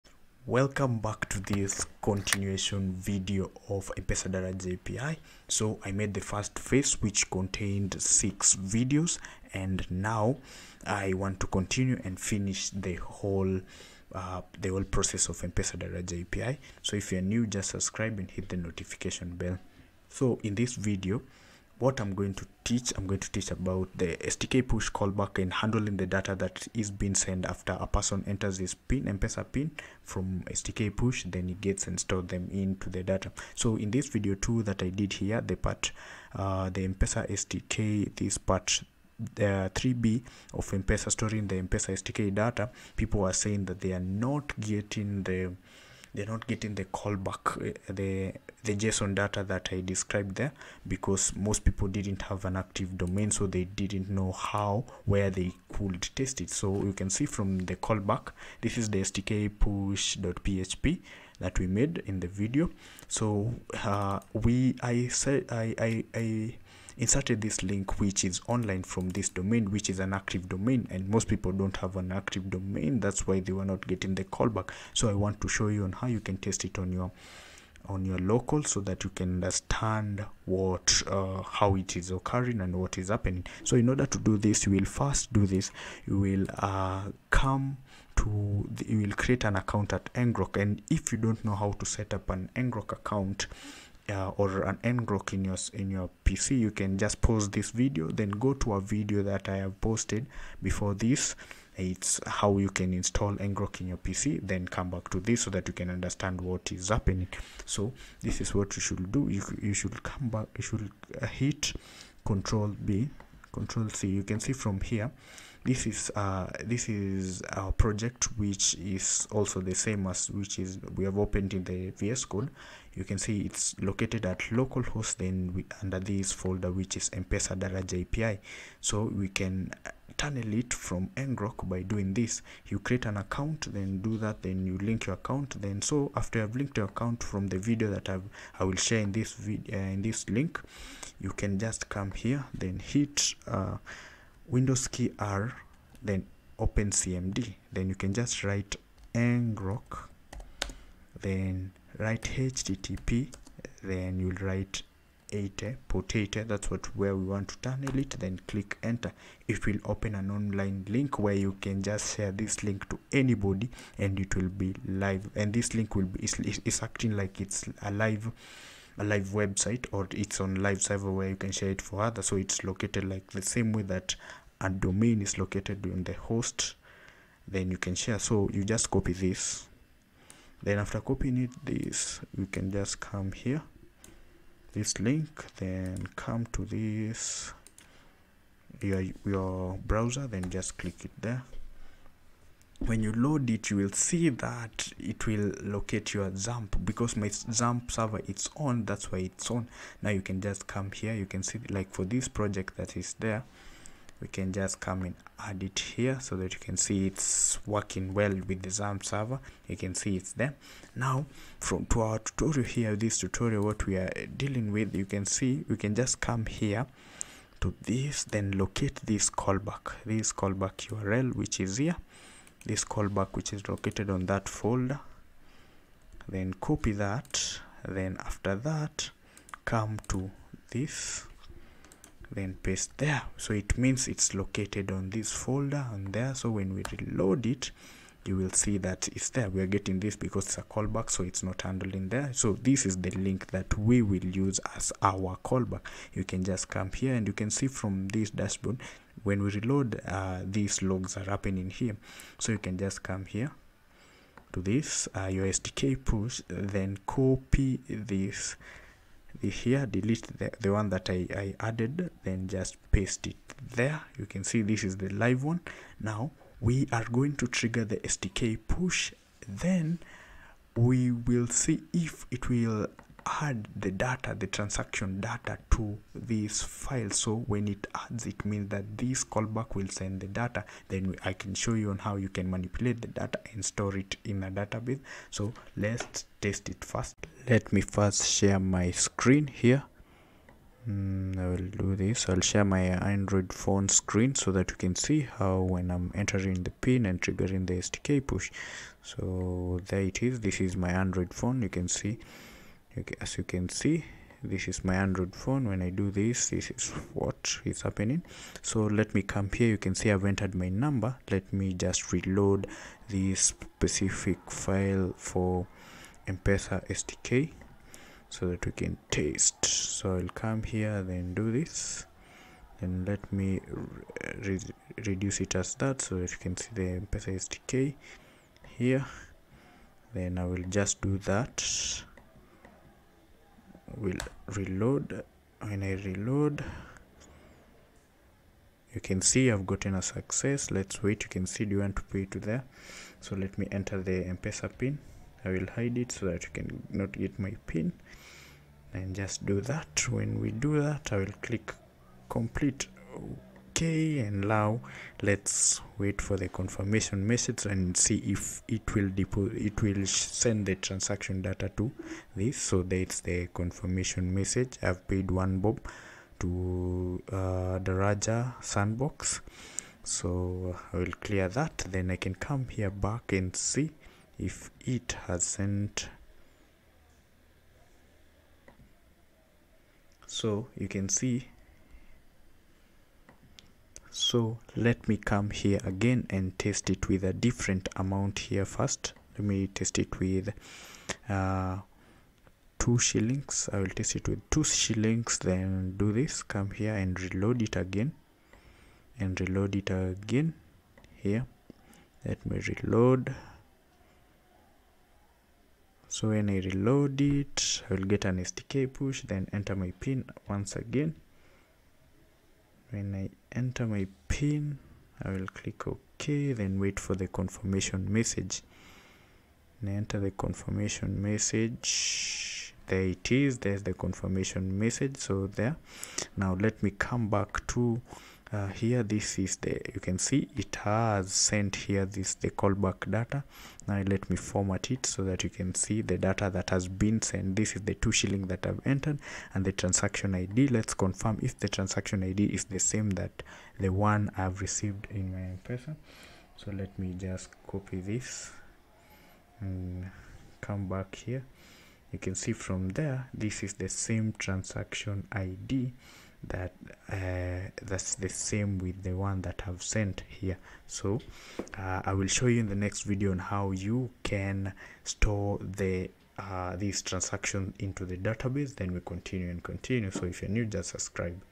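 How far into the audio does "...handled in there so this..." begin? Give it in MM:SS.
04:01.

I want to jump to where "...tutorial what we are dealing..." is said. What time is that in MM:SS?
03:33.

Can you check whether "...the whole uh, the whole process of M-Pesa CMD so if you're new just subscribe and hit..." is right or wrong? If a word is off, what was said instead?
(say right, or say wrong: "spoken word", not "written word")
wrong: "API", not "CMD".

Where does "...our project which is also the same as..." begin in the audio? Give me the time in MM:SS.
01:57.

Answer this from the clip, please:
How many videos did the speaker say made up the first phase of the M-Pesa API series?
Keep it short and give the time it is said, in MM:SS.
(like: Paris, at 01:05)
6, at 00:08.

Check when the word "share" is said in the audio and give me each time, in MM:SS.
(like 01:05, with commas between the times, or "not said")
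02:18, 02:42, 02:51, 02:57, 04:48, 04:52.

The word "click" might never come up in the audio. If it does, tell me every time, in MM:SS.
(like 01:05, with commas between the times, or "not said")
02:38, 03:10, 05:51, 06:55.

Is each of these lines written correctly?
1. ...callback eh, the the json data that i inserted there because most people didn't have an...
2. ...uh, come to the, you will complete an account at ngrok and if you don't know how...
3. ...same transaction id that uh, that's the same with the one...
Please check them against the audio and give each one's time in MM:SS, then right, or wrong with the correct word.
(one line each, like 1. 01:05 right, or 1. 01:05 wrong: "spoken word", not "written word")
1. 00:46 wrong: "described", not "inserted"
2. 01:26 wrong: "create", not "complete"
3. 07:33 right.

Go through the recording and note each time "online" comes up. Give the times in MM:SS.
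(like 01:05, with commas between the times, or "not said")
01:08, 02:40.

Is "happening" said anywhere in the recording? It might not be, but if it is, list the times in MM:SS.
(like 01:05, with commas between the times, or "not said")
01:23, 01:46, 04:11, 05:07.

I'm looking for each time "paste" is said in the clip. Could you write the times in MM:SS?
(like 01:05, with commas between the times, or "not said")
03:52, 04:22.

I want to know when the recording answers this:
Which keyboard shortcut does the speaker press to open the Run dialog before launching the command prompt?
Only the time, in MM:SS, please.
02:24.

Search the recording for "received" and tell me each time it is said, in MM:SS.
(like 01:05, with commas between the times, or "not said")
07:24.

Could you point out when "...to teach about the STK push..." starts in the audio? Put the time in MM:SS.
00:23.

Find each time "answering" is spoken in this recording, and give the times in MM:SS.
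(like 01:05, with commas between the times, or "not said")
not said.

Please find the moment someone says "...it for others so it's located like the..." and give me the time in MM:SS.
02:51.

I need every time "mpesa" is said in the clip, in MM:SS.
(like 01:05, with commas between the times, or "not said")
02:07, 05:44.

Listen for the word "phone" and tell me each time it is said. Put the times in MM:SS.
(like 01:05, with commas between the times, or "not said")
04:53, 05:01, 05:05.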